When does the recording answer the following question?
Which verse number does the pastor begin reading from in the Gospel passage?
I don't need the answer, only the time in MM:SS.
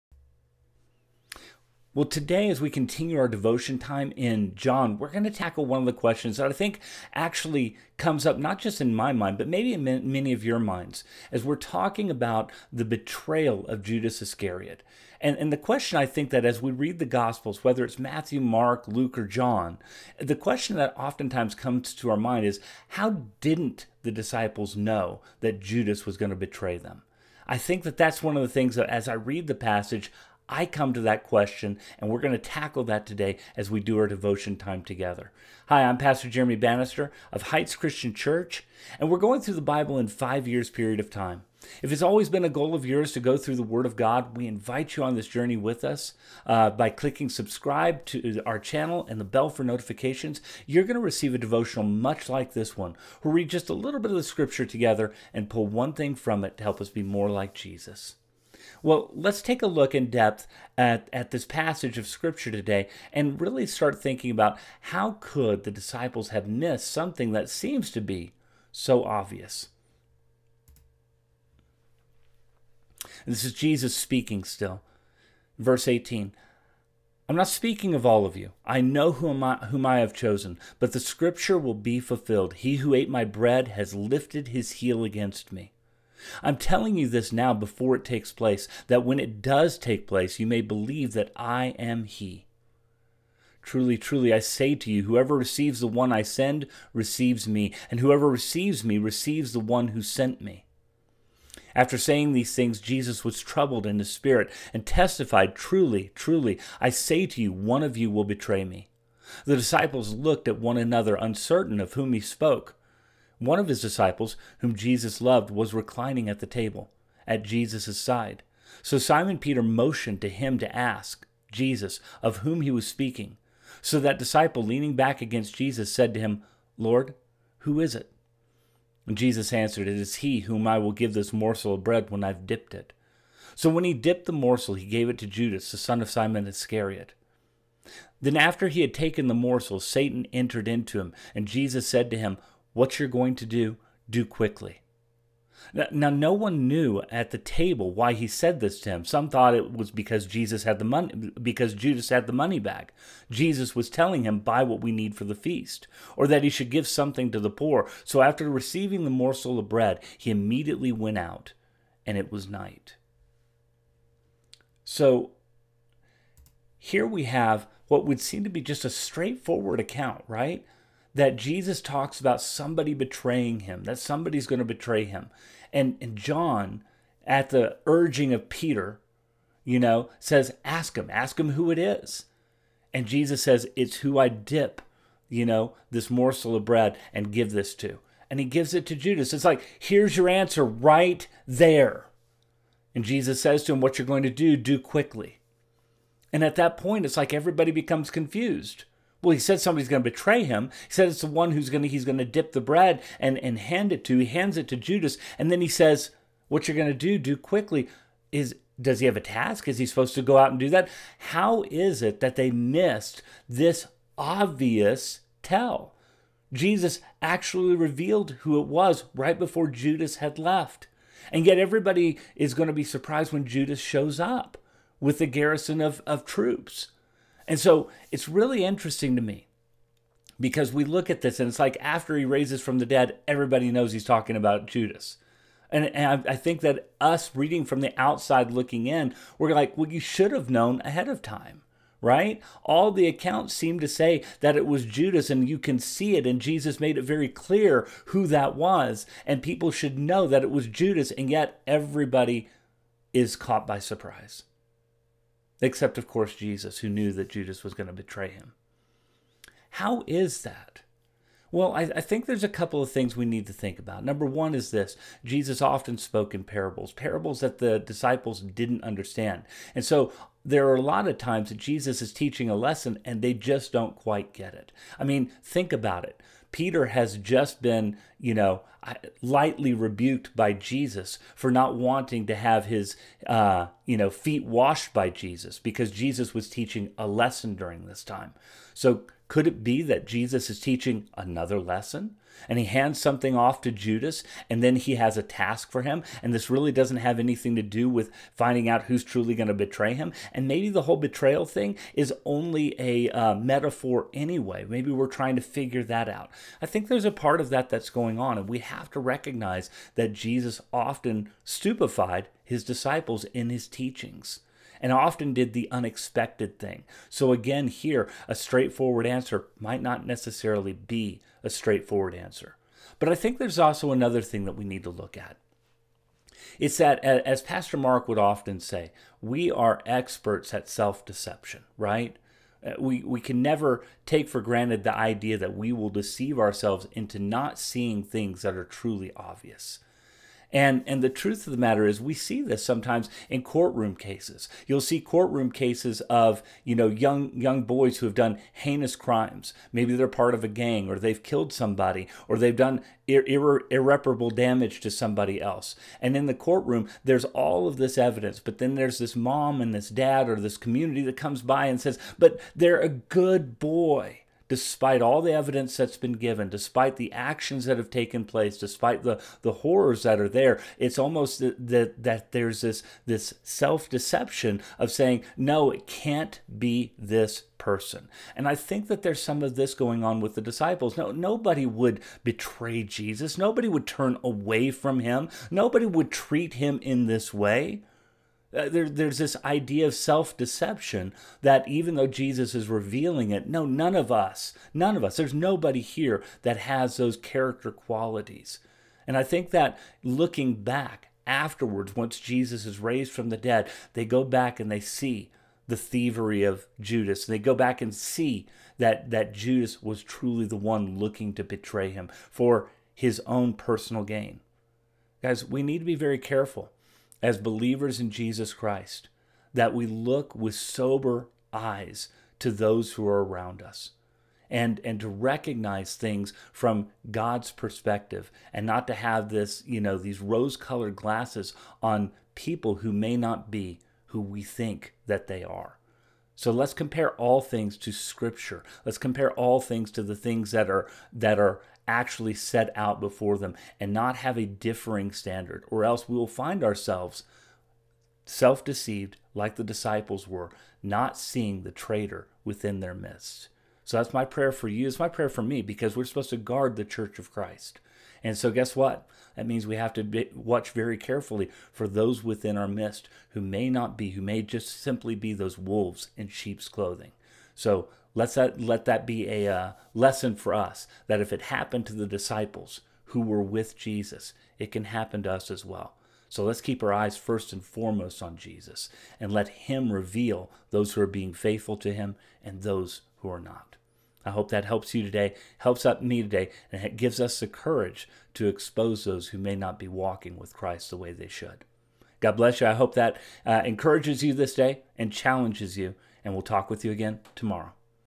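01:15.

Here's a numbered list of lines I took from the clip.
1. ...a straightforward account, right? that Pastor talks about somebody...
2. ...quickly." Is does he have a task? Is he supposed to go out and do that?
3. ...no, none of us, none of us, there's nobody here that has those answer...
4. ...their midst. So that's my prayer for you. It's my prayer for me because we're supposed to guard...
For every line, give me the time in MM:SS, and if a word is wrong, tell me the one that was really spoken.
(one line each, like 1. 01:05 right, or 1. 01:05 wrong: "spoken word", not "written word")
1. 02:48 wrong: "Jesus", not "Pastor"
2. 03:27 right
3. 06:33 wrong: "character", not "answer"
4. 07:32 right.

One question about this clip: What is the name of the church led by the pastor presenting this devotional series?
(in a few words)
Heights Christian Church.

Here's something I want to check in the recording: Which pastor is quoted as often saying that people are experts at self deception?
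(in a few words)
Pastor Mark.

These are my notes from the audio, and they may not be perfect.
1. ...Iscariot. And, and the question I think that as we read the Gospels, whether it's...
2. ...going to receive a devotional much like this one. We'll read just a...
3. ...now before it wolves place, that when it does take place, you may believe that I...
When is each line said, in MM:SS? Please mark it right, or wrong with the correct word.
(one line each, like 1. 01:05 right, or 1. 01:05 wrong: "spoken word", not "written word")
1. 00:14 right
2. 00:50 right
3. 01:27 wrong: "takes", not "wolves".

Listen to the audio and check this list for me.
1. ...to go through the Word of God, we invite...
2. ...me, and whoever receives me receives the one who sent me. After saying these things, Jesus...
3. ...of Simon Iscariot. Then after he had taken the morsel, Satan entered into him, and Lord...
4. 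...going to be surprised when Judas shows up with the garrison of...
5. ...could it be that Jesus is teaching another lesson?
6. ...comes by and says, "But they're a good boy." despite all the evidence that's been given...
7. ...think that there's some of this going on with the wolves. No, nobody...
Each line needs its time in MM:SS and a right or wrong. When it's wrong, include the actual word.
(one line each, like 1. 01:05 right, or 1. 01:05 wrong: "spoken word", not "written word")
1. 00:43 right
2. 01:37 right
3. 02:16 wrong: "Jesus", not "Lord"
4. 03:42 right
5. 04:49 right
6. 06:01 right
7. 06:18 wrong: "disciples", not "wolves".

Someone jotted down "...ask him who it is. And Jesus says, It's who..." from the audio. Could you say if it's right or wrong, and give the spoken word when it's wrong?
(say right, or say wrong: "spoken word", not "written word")
right.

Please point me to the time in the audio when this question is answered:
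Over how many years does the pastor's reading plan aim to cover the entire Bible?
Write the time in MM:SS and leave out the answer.
00:40.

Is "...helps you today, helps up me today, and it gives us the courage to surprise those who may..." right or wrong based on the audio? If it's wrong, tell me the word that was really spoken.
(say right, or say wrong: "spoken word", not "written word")
wrong: "expose", not "surprise".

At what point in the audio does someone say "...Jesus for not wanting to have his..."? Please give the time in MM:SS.
04:40.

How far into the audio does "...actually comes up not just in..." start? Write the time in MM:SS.
00:07.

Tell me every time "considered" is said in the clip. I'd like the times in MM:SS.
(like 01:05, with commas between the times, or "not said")
not said.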